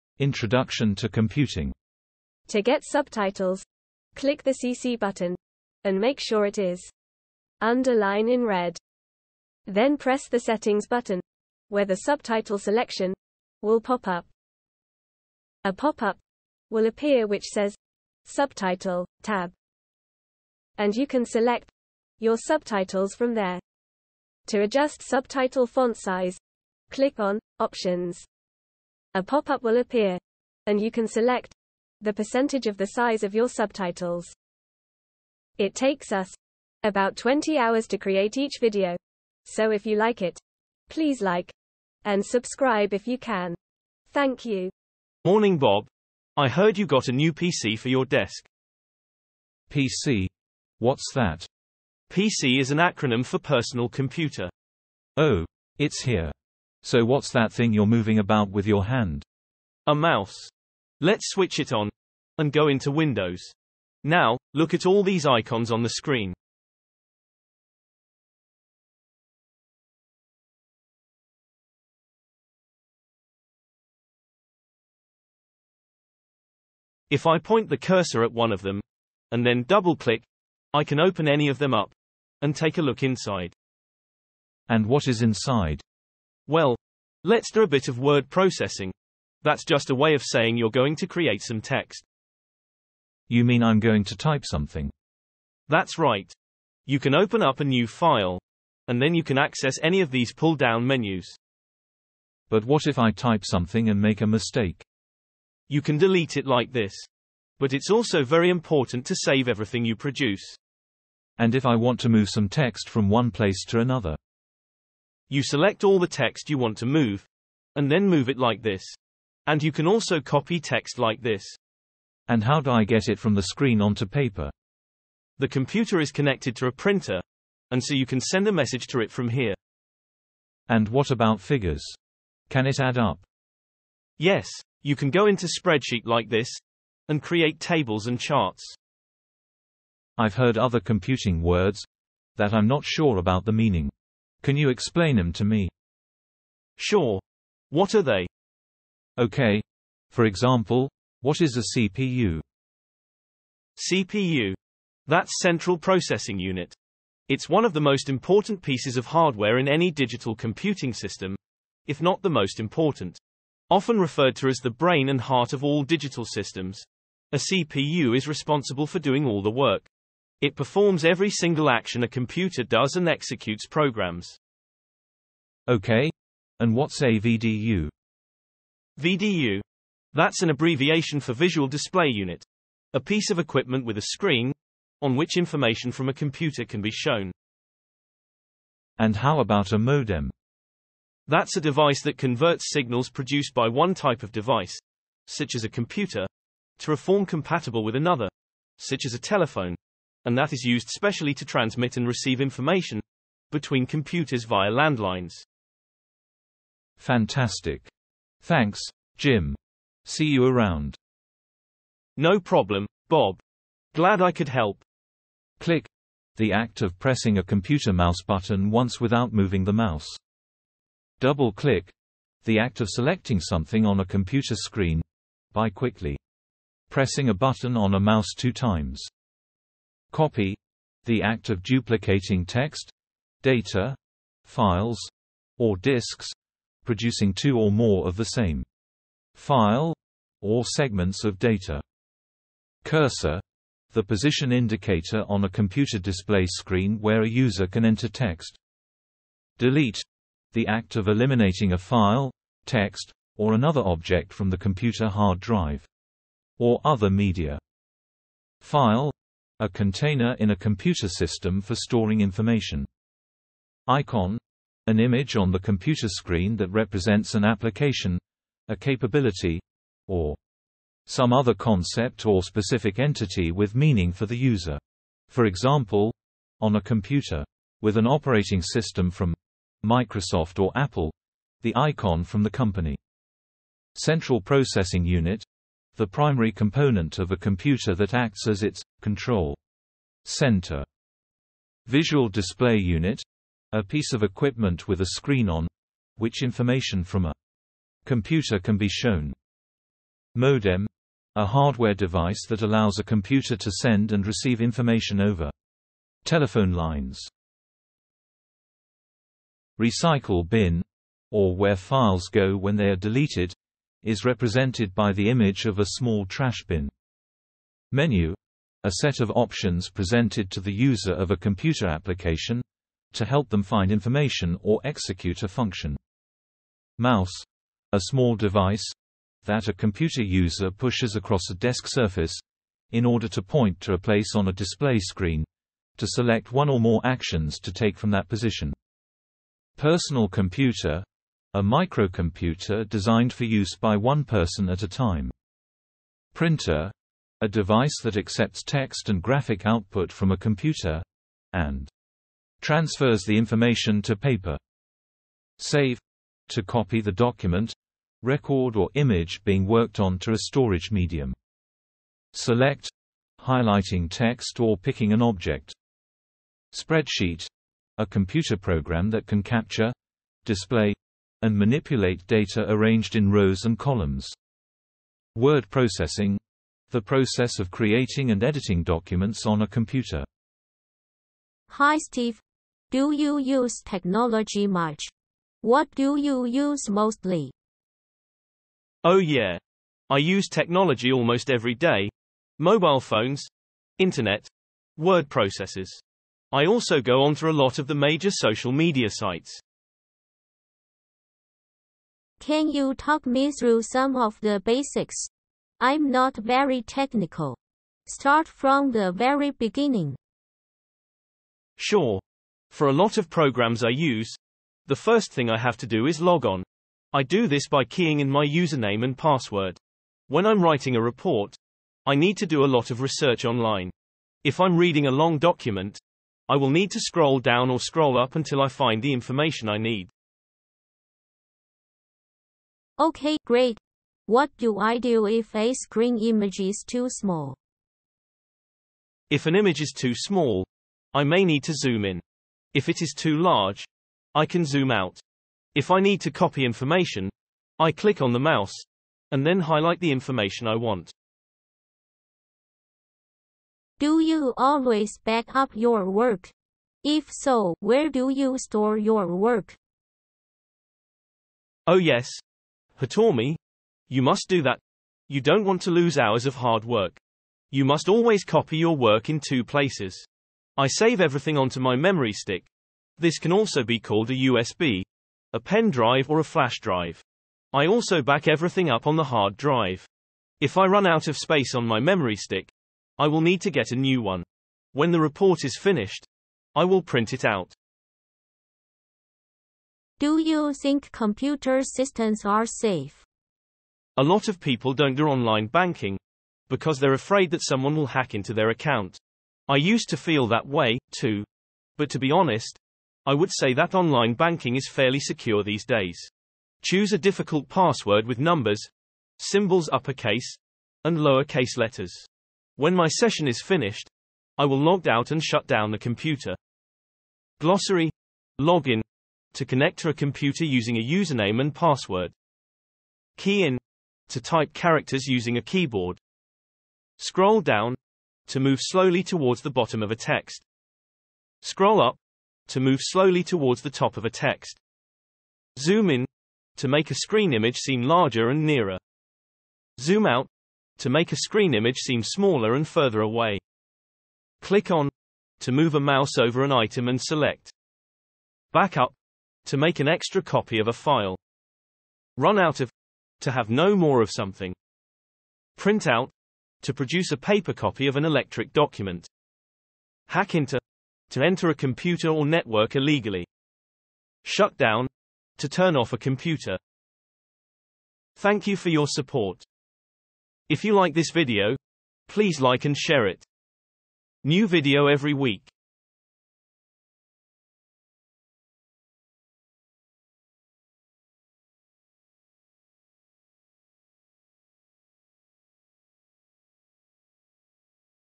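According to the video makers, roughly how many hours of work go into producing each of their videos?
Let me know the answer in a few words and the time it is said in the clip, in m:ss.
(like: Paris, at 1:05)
20 hours, at 0:37.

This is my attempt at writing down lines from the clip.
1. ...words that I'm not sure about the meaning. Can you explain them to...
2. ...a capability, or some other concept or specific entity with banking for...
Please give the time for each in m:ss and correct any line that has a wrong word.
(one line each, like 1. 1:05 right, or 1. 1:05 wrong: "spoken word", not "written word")
1. 2:21 right
2. 4:28 wrong: "meaning", not "banking".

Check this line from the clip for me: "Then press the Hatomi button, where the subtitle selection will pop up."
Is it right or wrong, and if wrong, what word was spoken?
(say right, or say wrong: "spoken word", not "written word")
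wrong: "Settings", not "Hatomi".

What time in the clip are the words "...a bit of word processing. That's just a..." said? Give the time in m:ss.
1:27.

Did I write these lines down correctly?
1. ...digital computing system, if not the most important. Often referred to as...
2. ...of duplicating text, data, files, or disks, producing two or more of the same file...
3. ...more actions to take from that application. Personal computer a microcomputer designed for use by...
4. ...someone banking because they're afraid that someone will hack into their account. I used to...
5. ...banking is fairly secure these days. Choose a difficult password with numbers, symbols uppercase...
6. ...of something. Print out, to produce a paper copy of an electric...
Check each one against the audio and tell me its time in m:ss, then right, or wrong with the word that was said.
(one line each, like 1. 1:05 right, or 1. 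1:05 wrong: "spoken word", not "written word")
1. 2:39 right
2. 3:51 right
3. 5:36 wrong: "position", not "application"
4. 8:15 wrong: "online", not "someone"
5. 8:24 right
6. 9:14 right.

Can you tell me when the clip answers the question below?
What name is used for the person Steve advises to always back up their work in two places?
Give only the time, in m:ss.
7:43.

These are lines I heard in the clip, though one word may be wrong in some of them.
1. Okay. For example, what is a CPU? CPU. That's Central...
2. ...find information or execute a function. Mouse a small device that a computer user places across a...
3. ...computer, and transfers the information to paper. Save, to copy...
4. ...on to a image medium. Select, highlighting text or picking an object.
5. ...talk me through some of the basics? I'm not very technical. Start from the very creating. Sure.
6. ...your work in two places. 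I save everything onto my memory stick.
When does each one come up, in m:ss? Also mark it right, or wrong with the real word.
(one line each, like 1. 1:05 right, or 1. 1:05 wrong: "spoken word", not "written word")
1. 2:29 right
2. 5:23 wrong: "pushes", not "places"
3. 5:50 right
4. 5:59 wrong: "storage", not "image"
5. 6:42 wrong: "beginning", not "creating"
6. 7:48 right.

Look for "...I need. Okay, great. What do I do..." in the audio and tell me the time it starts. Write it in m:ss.
7:09.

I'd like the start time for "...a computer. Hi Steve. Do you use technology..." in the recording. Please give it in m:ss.
6:19.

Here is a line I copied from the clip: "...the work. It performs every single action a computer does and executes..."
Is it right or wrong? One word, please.
right.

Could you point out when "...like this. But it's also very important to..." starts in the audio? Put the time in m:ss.
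1:46.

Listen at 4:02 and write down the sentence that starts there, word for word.
Cursor the position indicator on a computer display screen where a user can enter text.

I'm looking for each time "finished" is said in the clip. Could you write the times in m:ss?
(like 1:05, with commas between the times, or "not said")
8:05, 8:33.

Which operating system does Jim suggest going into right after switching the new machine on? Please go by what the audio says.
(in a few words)
Windows.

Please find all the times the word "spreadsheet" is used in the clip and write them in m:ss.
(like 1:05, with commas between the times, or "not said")
2:15, 6:06.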